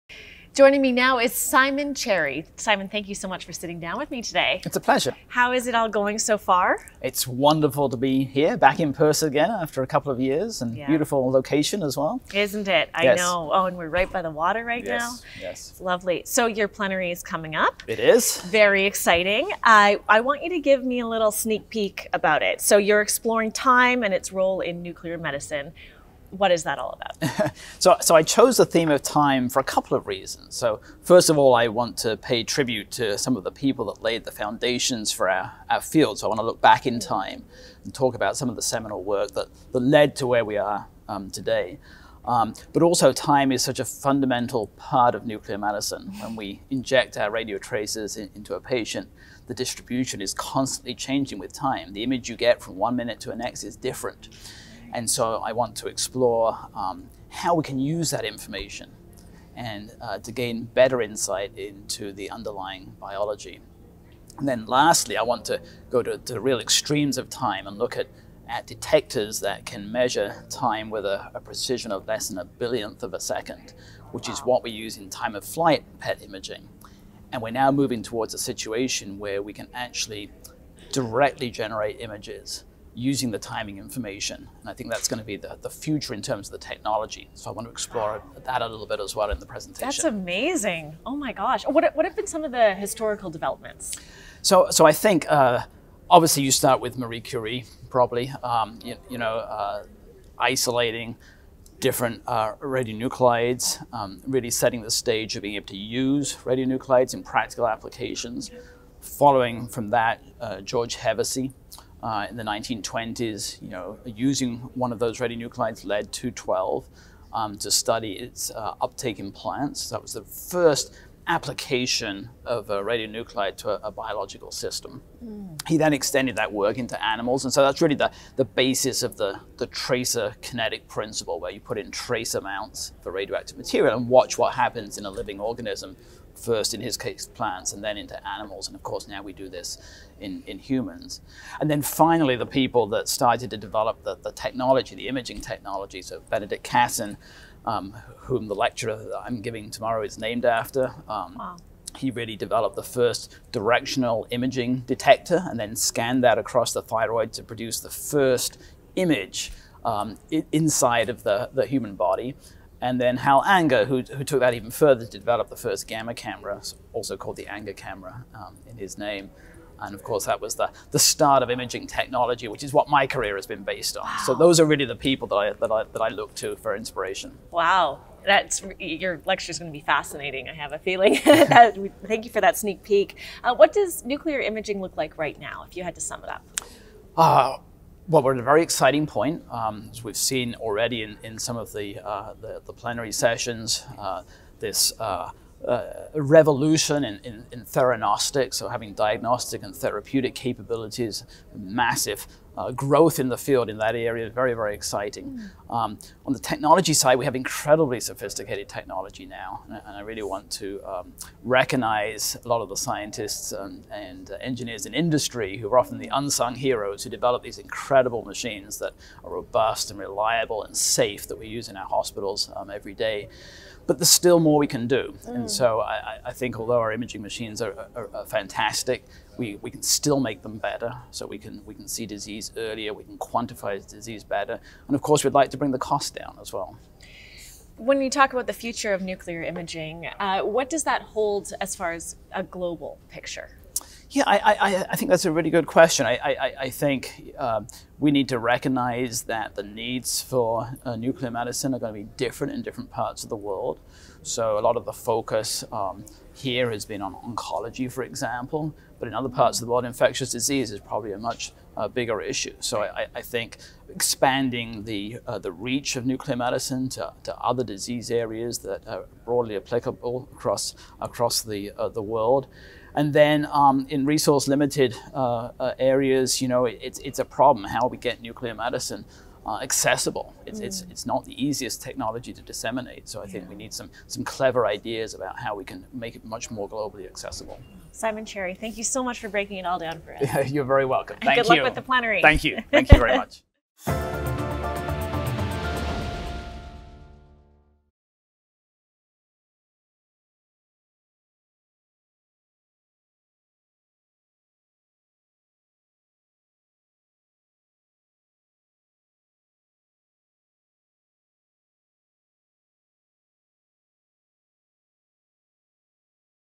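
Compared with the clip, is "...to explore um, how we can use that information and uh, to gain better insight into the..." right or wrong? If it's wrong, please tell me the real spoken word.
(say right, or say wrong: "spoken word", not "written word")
right.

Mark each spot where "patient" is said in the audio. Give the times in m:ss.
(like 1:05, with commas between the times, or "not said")
0:48.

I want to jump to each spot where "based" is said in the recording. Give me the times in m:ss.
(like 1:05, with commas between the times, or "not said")
2:53.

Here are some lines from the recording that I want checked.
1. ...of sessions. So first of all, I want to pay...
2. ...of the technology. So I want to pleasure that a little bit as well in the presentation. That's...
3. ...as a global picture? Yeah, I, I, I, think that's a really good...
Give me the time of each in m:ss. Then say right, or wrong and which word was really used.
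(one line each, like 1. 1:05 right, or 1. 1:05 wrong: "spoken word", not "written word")
1. 0:29 wrong: "reasons", not "sessions"
2. 1:26 wrong: "explore", not "pleasure"
3. 4:01 right.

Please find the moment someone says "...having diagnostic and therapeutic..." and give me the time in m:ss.
3:18.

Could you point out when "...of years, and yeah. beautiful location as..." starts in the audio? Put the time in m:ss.
0:10.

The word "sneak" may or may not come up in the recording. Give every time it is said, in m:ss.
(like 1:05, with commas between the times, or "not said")
0:21, 3:02.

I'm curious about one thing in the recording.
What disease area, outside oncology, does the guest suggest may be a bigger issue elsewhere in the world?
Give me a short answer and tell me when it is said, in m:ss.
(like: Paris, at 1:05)
infectious disease, at 4:19.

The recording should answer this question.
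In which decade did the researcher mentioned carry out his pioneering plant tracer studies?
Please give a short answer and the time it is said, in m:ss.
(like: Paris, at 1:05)
1920s, at 1:52.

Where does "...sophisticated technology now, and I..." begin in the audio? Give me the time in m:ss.
3:27.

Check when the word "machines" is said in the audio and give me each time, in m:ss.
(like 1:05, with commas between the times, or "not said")
3:38, 3:47.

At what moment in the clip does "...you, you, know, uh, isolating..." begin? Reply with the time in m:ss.
1:38.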